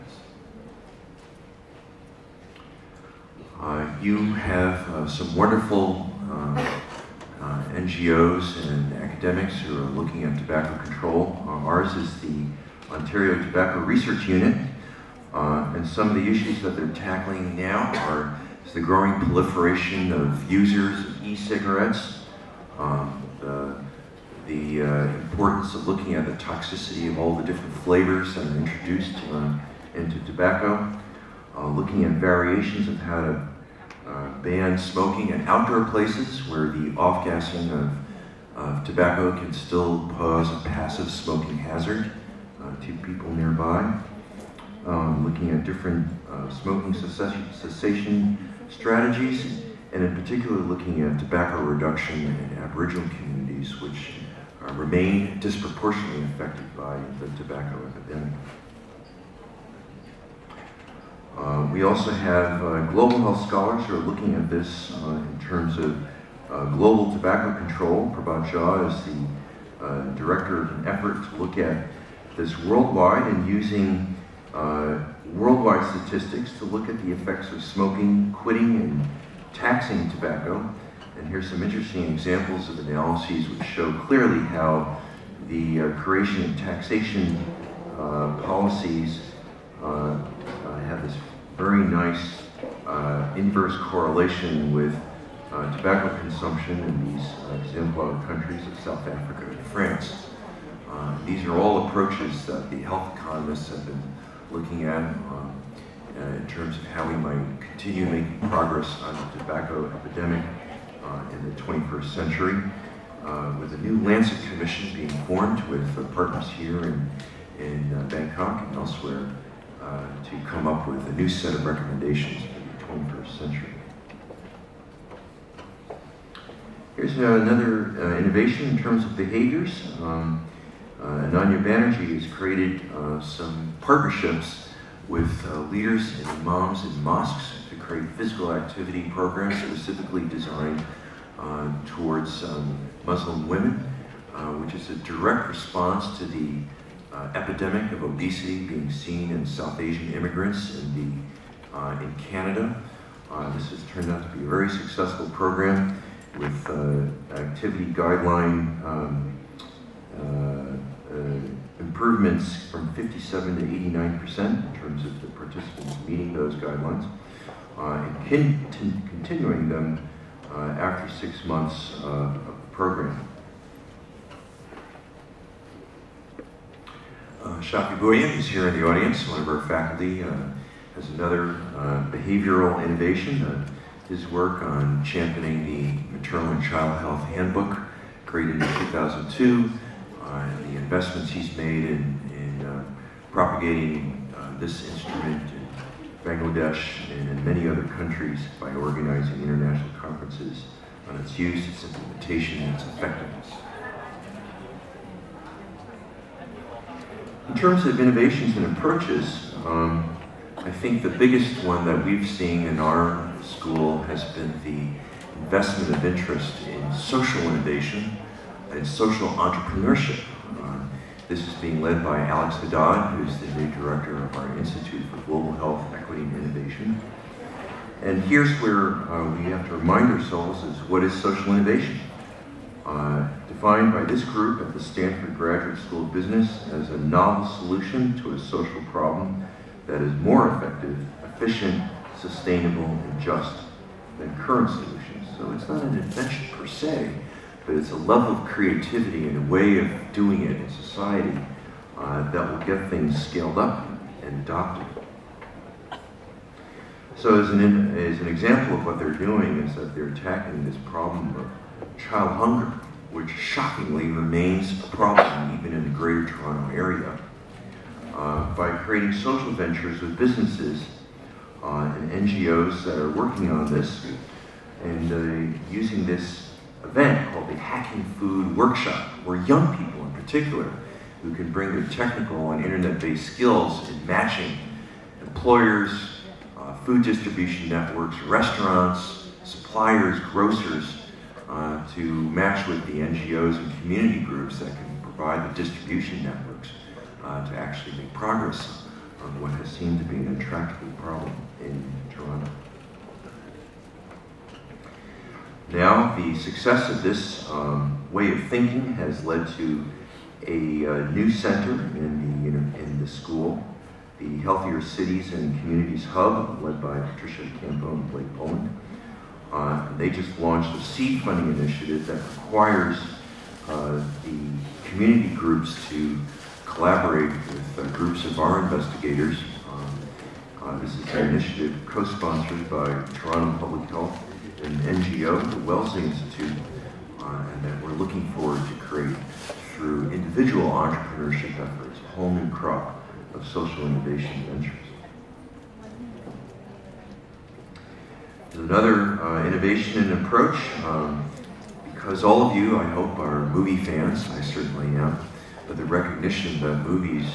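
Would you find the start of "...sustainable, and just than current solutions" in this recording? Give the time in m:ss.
4:02.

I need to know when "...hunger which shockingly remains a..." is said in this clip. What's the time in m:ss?
4:22.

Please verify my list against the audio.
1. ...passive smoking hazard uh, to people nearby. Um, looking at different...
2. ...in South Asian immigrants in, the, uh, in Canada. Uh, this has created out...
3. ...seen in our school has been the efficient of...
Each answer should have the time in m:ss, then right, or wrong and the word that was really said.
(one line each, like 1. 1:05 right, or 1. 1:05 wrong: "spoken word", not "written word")
1. 0:40 right
2. 2:29 wrong: "turned", not "created"
3. 3:32 wrong: "investment", not "efficient".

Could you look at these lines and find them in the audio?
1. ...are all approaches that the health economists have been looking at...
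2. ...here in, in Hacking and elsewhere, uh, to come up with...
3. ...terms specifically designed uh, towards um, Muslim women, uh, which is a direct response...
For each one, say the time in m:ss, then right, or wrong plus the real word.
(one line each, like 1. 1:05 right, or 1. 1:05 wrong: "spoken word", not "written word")
1. 1:41 right
2. 1:56 wrong: "Bangkok", not "Hacking"
3. 2:19 wrong: "programs", not "terms".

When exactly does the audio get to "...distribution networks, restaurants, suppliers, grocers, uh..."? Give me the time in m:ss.
4:47.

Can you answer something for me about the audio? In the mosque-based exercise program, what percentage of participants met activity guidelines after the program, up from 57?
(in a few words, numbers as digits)
89%.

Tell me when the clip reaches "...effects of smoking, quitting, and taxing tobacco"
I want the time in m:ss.
1:17.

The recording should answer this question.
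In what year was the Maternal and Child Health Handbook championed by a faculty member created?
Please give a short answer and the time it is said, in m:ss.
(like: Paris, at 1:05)
2002, at 3:08.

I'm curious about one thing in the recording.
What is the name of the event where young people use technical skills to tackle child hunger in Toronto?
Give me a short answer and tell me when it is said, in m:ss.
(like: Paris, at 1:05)
Hacking Food Workshop, at 4:37.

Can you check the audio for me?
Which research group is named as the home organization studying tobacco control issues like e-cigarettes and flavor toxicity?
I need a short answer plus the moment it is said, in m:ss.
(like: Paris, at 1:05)
Ontario Tobacco Research Unit, at 0:12.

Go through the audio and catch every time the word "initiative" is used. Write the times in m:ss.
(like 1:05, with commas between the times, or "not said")
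5:21, 5:31.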